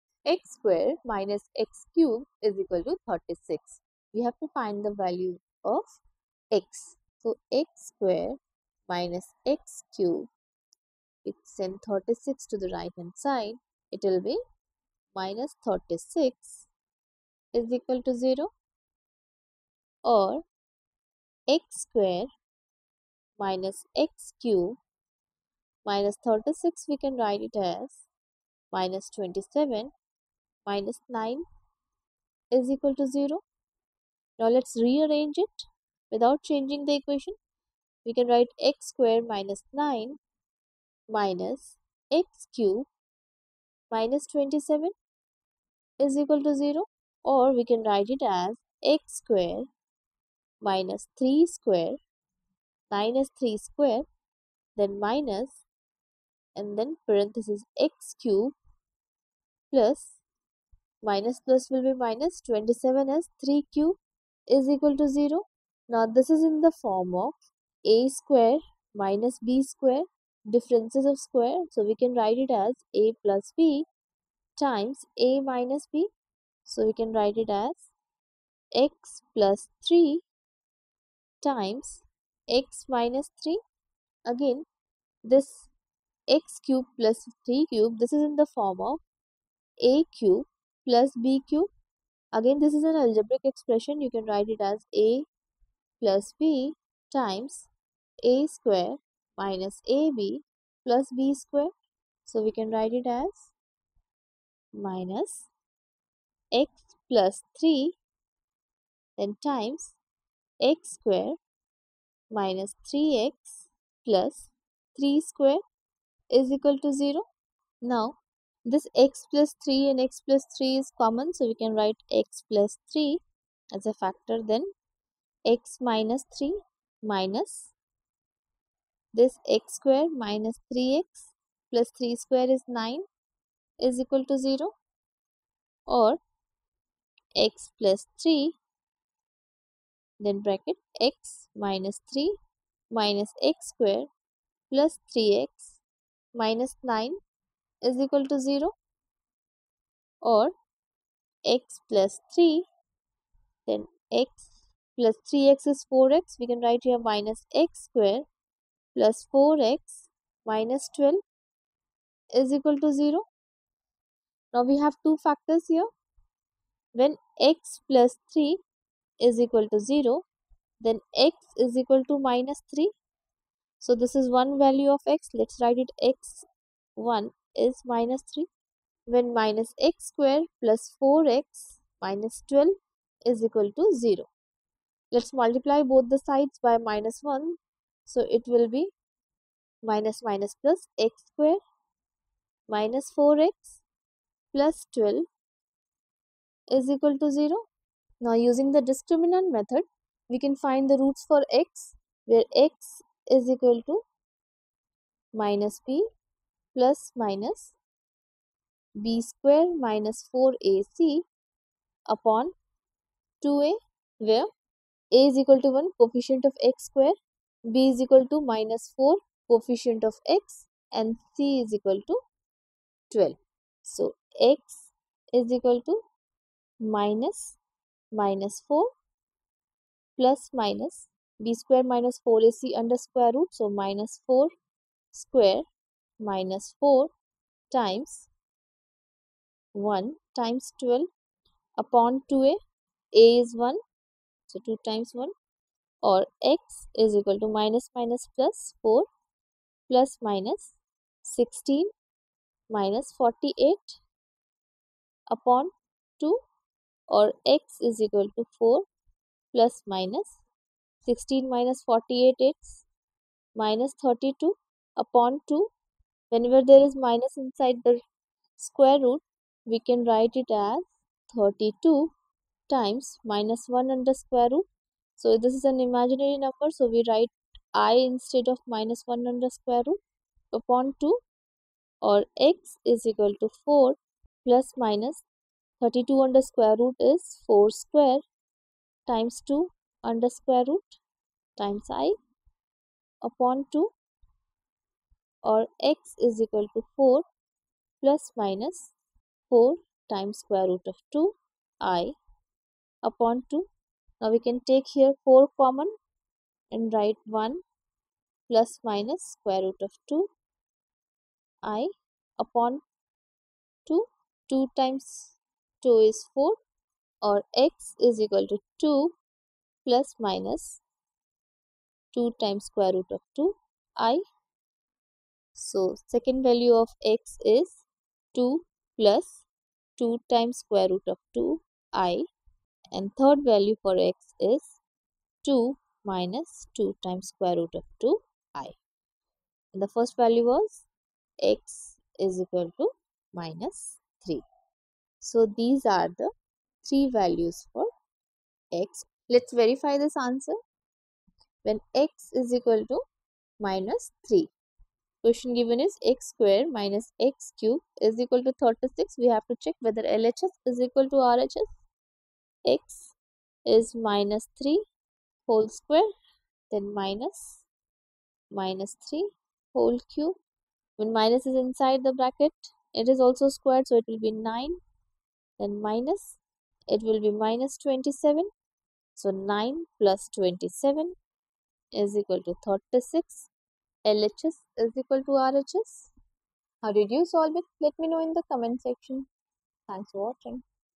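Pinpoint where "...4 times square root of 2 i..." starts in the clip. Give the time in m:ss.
4:59.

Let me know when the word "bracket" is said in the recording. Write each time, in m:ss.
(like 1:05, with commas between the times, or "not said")
2:20, 6:12.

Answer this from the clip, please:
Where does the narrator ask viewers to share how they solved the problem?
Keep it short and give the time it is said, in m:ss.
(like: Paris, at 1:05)
comment section, at 6:28.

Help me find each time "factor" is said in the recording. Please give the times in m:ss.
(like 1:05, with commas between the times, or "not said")
2:03, 2:45.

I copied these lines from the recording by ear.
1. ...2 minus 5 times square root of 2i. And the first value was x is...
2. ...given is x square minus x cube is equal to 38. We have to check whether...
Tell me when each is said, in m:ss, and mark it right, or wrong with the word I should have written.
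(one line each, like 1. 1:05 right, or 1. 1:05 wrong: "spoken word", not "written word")
1. 5:35 wrong: "2", not "5"
2. 5:55 wrong: "36", not "38".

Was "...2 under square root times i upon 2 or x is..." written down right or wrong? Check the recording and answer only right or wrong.
right.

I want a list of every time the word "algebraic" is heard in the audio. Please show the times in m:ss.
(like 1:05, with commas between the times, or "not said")
1:33.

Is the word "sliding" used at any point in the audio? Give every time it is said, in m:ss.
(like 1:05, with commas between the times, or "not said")
not said.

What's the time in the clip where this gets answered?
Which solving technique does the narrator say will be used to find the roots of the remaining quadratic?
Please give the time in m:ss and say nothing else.
3:18.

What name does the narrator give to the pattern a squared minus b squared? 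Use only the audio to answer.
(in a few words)
differences of square.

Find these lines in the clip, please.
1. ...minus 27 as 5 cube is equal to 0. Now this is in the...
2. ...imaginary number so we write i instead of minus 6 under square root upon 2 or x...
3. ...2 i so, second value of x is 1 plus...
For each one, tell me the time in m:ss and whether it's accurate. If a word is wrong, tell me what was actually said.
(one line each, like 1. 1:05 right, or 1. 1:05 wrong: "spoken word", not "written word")
1. 1:01 wrong: "3", not "5"
2. 4:35 wrong: "1", not "6"
3. 5:23 wrong: "2", not "1".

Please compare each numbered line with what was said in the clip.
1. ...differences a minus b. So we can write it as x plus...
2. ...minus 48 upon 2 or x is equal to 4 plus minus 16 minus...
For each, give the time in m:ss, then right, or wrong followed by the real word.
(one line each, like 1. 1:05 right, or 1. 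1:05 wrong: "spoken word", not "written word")
1. 1:14 wrong: "times", not "differences"
2. 4:12 right.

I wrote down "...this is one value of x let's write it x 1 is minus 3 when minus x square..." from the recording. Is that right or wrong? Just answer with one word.
right.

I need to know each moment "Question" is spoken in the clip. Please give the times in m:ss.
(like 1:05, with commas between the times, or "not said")
5:55.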